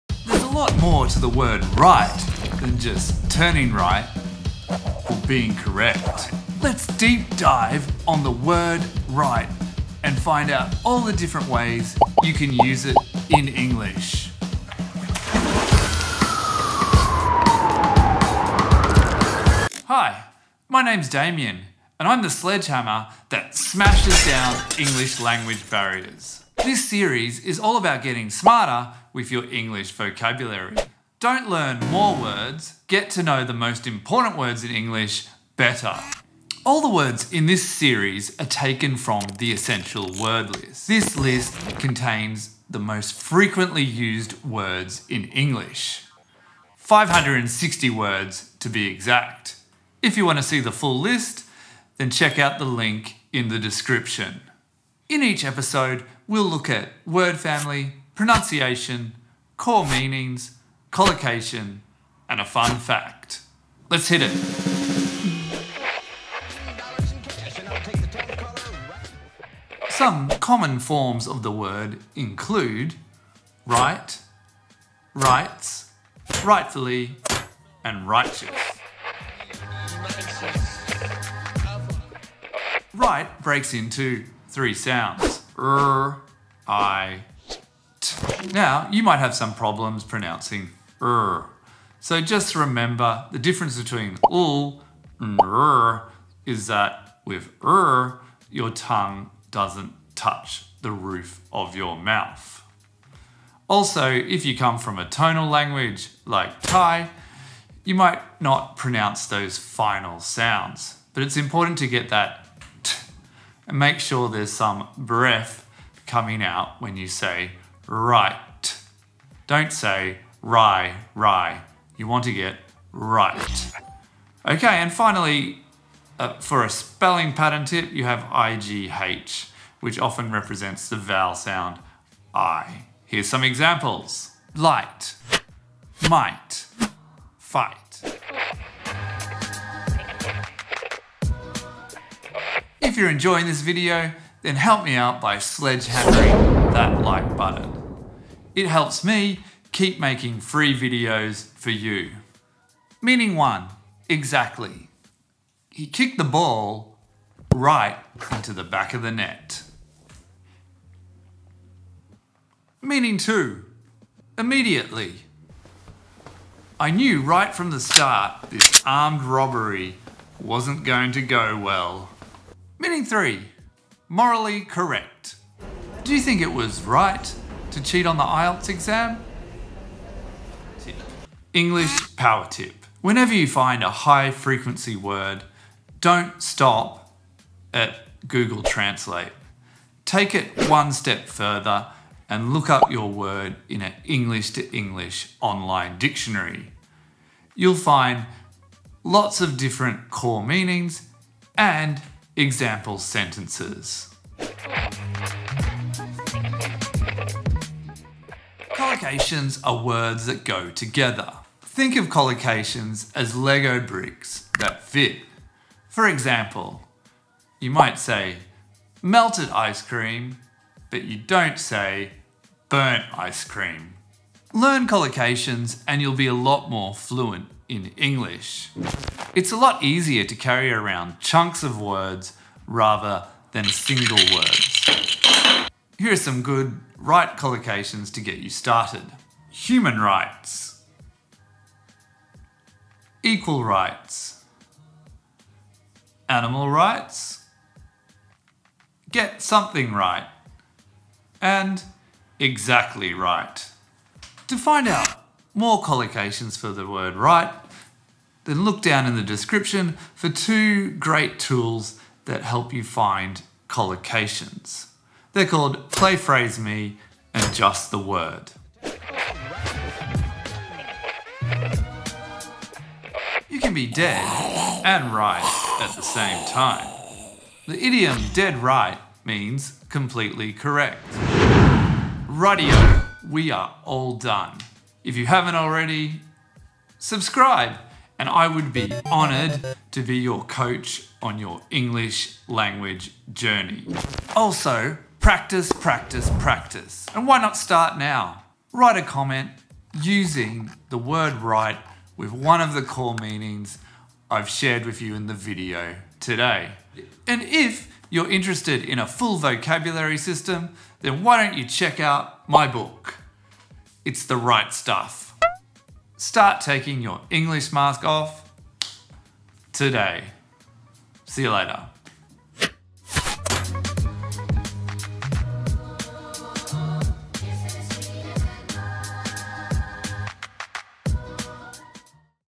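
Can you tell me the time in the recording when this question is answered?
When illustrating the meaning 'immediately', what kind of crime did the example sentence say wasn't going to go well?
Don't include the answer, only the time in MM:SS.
02:48.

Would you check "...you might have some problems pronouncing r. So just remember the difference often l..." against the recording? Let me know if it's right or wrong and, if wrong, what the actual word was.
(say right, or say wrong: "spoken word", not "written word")
wrong: "between", not "often".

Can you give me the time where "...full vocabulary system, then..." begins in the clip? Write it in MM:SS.
05:09.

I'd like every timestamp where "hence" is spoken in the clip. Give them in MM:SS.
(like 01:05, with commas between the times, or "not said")
not said.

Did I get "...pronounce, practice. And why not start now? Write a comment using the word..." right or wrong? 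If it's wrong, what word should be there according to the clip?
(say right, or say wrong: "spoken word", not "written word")
wrong: "practice", not "pronounce".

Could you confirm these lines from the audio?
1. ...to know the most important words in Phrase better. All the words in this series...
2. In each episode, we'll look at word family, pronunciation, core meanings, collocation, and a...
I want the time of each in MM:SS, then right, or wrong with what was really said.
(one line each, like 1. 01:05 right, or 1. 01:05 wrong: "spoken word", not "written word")
1. 00:33 wrong: "English", not "Phrase"
2. 00:55 right.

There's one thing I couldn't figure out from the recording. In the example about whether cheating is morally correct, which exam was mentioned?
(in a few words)
IELTS.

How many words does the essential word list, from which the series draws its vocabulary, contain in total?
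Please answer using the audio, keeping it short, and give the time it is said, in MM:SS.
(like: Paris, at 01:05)
560, at 00:46.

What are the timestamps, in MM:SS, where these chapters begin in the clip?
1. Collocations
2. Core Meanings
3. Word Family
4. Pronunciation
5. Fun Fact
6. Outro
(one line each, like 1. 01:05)
1. 03:25
2. 02:18
3. 01:06
4. 01:18
5. 04:29
6. 04:42.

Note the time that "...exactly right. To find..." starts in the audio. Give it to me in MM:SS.
04:12.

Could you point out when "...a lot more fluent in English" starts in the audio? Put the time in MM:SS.
03:46.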